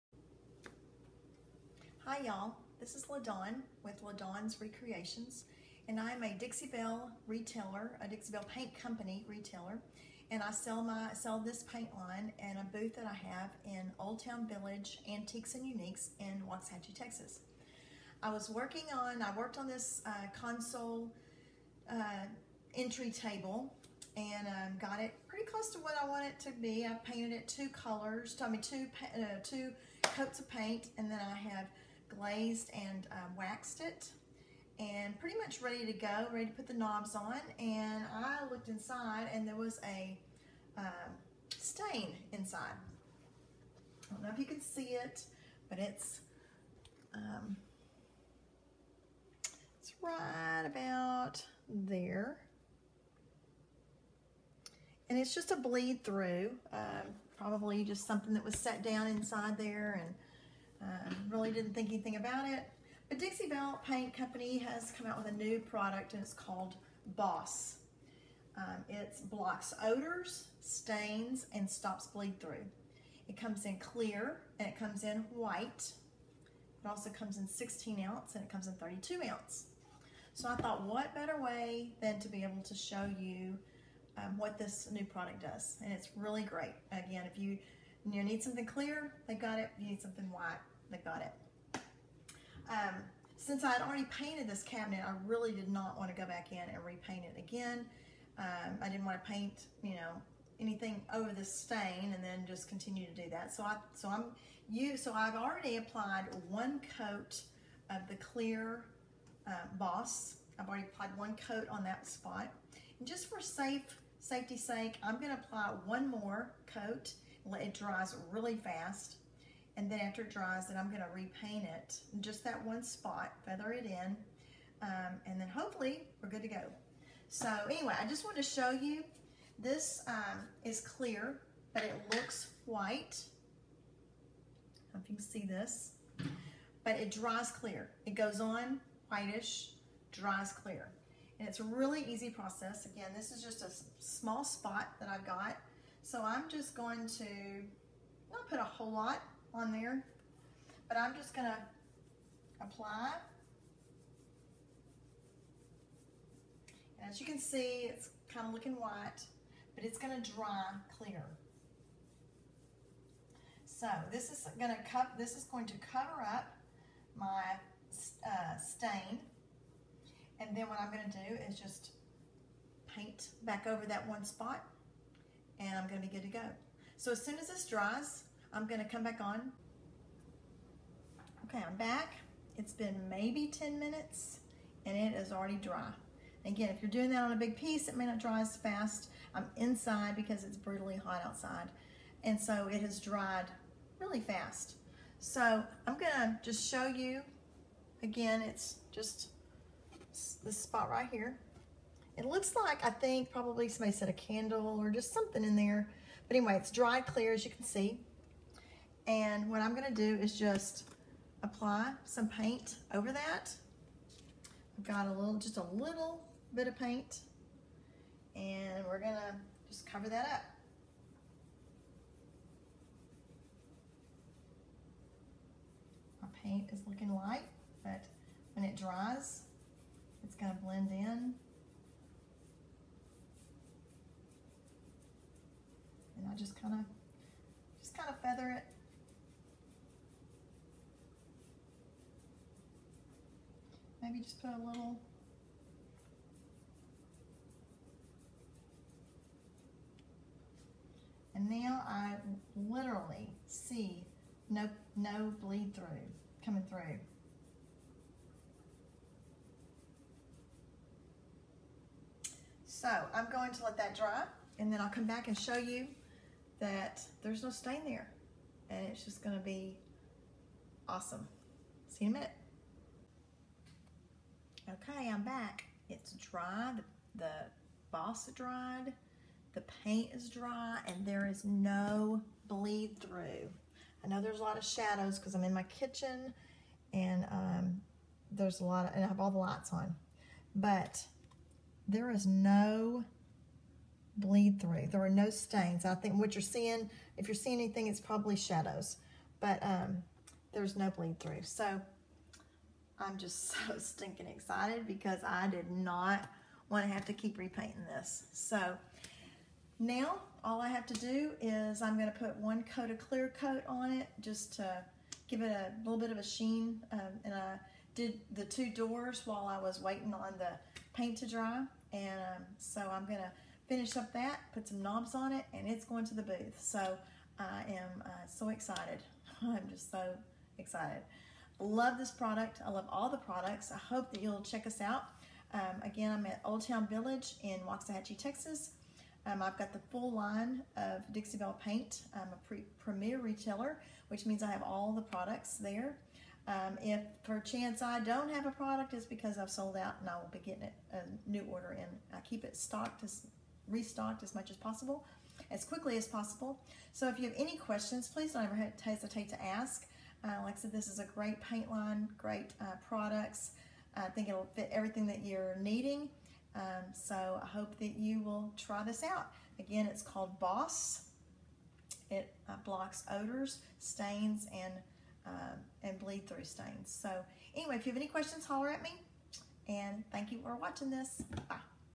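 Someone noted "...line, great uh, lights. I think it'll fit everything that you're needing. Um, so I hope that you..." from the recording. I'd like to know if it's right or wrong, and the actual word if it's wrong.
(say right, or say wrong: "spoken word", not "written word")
wrong: "products", not "lights".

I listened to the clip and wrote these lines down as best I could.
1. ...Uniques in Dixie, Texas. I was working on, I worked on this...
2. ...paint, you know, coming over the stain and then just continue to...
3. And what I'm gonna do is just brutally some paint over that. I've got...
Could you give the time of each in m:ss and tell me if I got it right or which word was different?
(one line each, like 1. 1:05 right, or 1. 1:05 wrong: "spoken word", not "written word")
1. 0:15 wrong: "Waxahachie", not "Dixie"
2. 1:39 wrong: "anything", not "coming"
3. 3:29 wrong: "apply", not "brutally".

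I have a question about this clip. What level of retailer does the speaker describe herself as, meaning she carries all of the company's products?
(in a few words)
Premier retailer.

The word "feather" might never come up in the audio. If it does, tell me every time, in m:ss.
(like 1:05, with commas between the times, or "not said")
2:03, 3:58.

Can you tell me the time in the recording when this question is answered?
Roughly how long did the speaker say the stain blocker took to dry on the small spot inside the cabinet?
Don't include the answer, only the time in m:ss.
3:03.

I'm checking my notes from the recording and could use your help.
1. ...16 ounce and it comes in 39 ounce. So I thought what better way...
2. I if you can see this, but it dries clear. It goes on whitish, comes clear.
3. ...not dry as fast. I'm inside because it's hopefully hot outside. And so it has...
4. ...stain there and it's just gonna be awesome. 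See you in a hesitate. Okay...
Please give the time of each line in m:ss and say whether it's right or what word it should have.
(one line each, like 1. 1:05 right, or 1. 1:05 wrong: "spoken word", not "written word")
1. 1:17 wrong: "32", not "39"
2. 2:14 wrong: "dries", not "comes"
3. 3:08 wrong: "brutally", not "hopefully"
4. 4:27 wrong: "minute", not "hesitate".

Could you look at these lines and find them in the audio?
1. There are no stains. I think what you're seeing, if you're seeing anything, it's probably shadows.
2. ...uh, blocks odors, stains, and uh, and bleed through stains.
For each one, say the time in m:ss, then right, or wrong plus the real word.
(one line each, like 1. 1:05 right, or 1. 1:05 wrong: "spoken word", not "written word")
1. 4:54 right
2. 6:12 right.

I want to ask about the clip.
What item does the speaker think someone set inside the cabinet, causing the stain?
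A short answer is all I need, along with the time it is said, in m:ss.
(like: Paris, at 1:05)
A candle, at 3:24.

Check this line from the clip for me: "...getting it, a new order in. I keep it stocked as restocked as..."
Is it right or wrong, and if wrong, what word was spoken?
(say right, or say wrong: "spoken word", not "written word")
right.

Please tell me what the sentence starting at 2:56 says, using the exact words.
So as soon as this dries, I'm gonna come back on.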